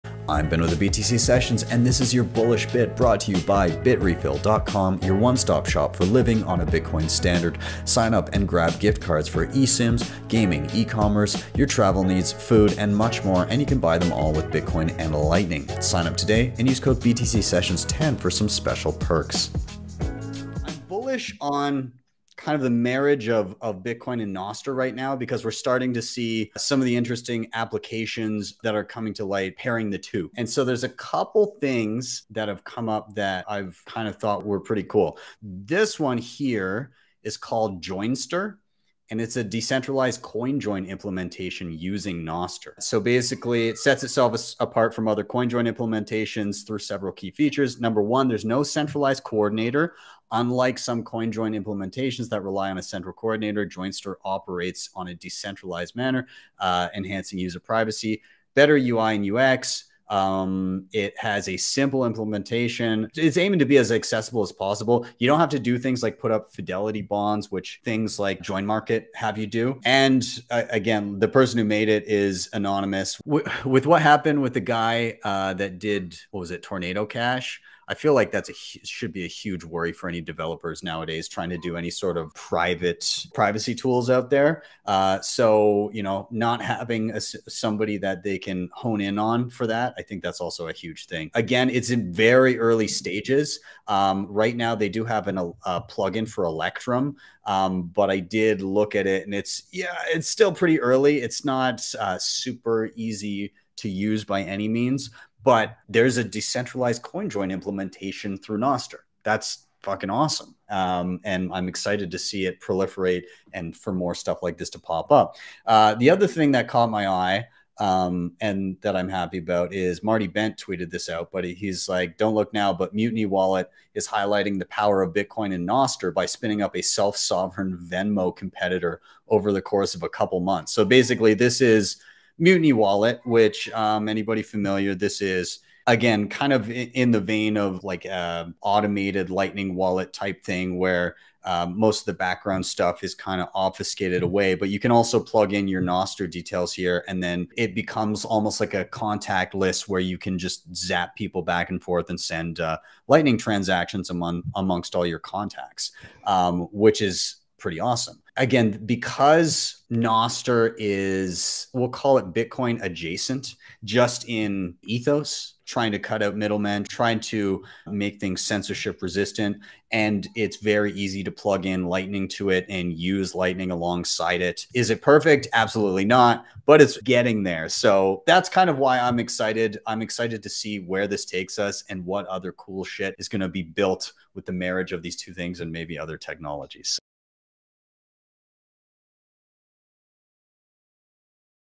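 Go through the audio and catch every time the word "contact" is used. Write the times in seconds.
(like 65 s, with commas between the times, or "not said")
148 s, 155 s.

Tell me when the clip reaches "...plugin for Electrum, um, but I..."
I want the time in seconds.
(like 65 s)
95 s.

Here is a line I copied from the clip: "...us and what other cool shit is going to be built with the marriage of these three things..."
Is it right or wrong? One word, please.
wrong.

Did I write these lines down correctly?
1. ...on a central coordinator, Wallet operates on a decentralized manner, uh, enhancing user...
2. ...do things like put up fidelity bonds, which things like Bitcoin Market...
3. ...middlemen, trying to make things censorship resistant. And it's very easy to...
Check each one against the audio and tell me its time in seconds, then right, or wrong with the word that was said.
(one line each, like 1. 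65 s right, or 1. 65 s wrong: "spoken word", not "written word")
1. 52 s wrong: "Joinstr", not "Wallet"
2. 65 s wrong: "Join", not "Bitcoin"
3. 166 s right.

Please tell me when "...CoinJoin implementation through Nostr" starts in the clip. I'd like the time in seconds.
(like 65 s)
107 s.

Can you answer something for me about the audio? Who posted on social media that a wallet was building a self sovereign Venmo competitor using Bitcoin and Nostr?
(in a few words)
Marty Bent.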